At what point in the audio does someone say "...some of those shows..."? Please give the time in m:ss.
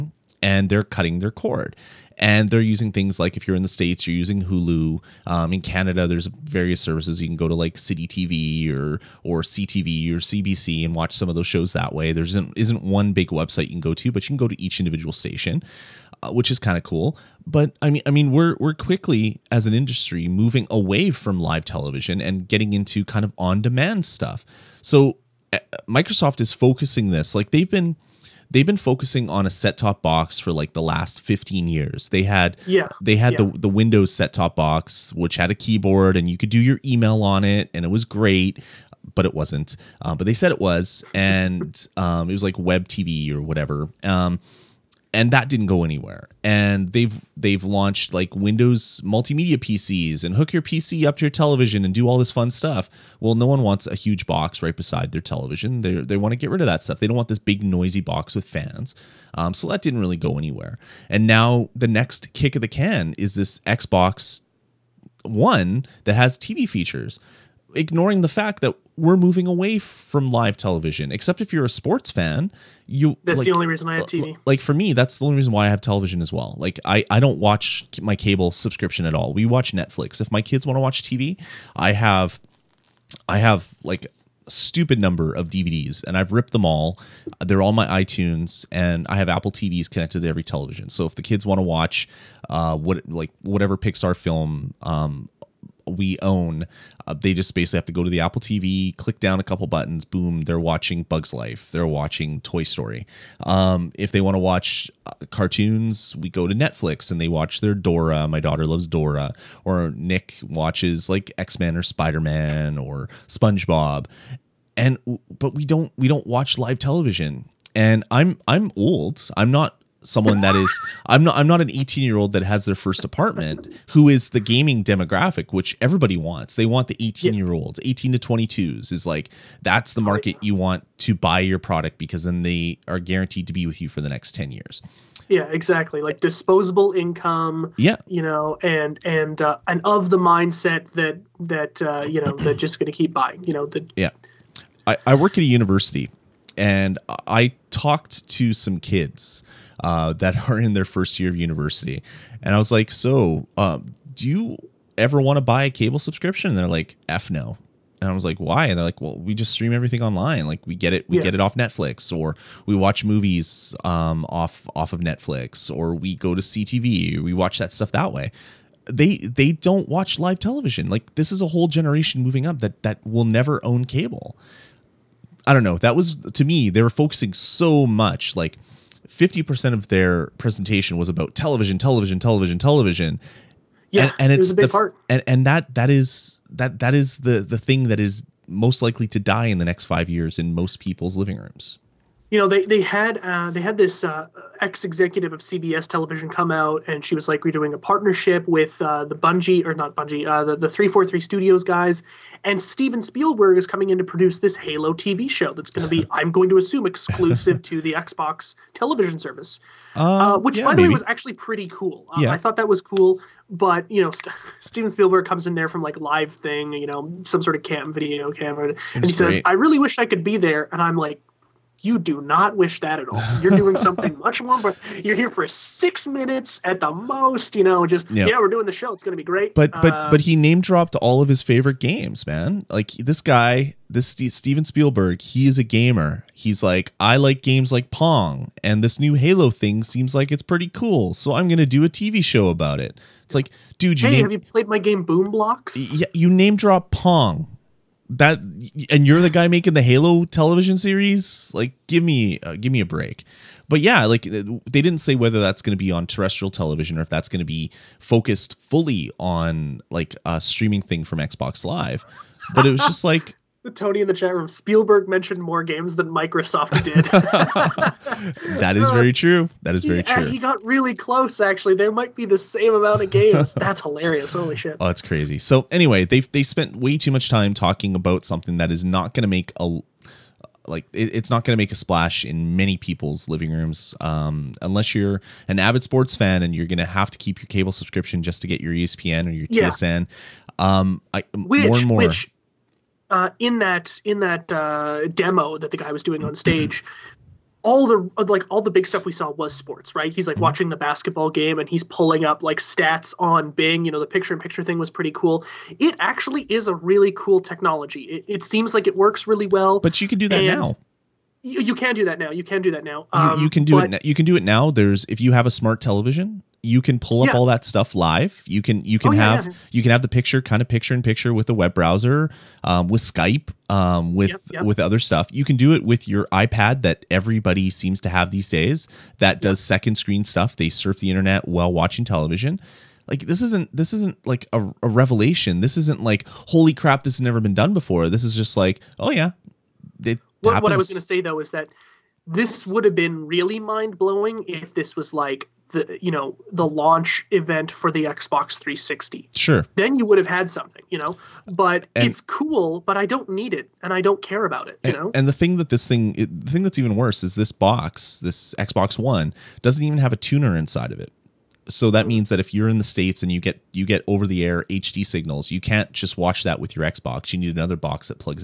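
0:11.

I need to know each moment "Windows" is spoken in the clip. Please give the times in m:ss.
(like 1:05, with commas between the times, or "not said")
0:33, 0:48.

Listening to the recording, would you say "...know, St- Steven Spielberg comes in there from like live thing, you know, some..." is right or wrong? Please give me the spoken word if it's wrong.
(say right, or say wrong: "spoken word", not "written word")
right.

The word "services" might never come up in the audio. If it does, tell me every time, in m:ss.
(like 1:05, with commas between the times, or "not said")
0:06, 3:29.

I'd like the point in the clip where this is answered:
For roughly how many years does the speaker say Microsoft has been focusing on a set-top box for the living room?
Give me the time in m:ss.
0:31.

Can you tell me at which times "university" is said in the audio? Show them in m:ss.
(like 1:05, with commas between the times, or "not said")
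2:25, 2:31.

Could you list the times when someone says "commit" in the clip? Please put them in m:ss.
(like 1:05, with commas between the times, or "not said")
not said.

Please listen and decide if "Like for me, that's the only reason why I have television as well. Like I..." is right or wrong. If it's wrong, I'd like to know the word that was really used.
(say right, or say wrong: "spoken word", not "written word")
right.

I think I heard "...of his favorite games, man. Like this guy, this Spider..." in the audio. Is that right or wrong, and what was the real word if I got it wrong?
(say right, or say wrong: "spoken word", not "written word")
wrong: "Steven", not "Spider".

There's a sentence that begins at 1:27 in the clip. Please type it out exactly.
They're all my iTunes and I have Apple TVs connected to every television.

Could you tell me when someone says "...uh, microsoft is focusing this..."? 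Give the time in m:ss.
0:25.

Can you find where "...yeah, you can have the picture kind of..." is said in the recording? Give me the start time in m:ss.
5:19.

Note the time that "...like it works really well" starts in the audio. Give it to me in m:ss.
5:08.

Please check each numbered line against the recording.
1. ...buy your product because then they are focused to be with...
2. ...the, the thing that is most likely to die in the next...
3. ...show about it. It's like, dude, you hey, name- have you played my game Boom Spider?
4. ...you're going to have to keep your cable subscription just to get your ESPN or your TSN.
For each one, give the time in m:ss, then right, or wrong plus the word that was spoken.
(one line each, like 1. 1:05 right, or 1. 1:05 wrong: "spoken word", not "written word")
1. 2:11 wrong: "guaranteed", not "focused"
2. 3:07 right
3. 4:02 wrong: "Blox", not "Spider"
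4. 4:46 right.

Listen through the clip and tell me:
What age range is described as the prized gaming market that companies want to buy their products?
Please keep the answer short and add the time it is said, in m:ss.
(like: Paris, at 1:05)
18 to 22, at 2:07.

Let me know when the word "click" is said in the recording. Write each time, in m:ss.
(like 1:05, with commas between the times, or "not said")
1:38.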